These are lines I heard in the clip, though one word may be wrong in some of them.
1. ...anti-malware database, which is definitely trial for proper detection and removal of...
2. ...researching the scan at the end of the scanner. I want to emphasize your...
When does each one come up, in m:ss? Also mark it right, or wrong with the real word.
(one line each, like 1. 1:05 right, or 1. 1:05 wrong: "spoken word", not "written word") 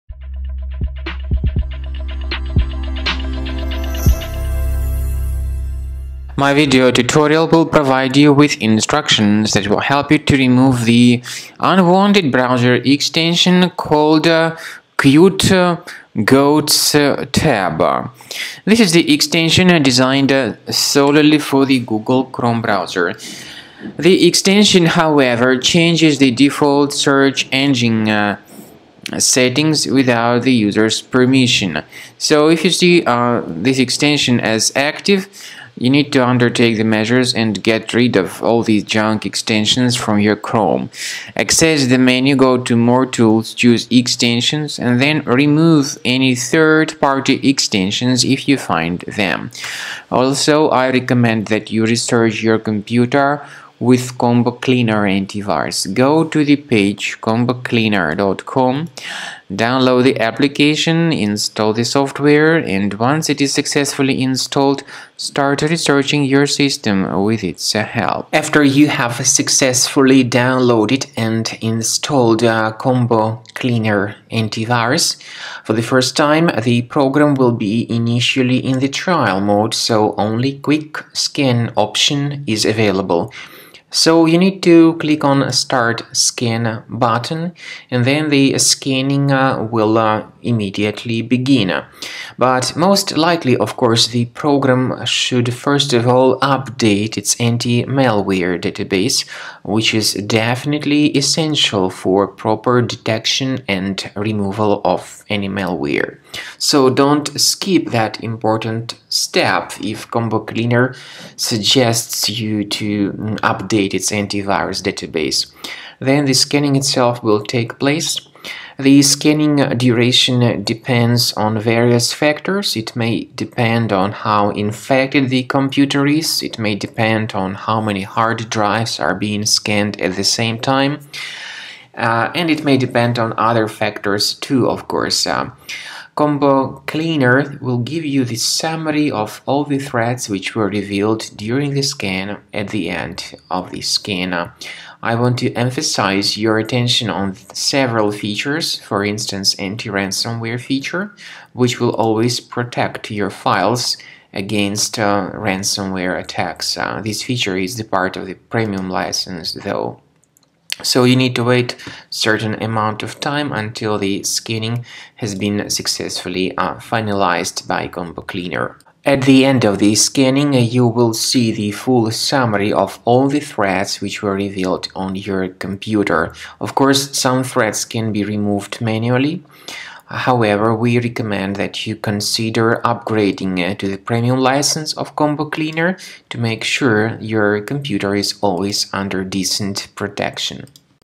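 1. 1:37 wrong: "essential", not "trial"
2. 2:21 wrong: "during", not "researching".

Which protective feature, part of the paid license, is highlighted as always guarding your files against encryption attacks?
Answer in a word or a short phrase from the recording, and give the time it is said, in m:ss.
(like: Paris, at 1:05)
anti-ransomware, at 2:29.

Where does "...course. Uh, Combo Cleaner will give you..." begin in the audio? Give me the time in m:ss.
2:14.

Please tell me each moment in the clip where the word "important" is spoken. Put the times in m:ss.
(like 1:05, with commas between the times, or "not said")
1:48.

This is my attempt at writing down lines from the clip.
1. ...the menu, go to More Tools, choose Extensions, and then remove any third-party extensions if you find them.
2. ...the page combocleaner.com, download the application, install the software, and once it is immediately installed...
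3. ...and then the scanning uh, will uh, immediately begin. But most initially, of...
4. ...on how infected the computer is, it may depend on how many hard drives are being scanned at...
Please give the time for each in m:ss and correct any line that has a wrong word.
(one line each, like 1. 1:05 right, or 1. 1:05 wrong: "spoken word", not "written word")
1. 0:41 right
2. 0:56 wrong: "successfully", not "immediately"
3. 1:27 wrong: "likely", not "initially"
4. 2:03 right.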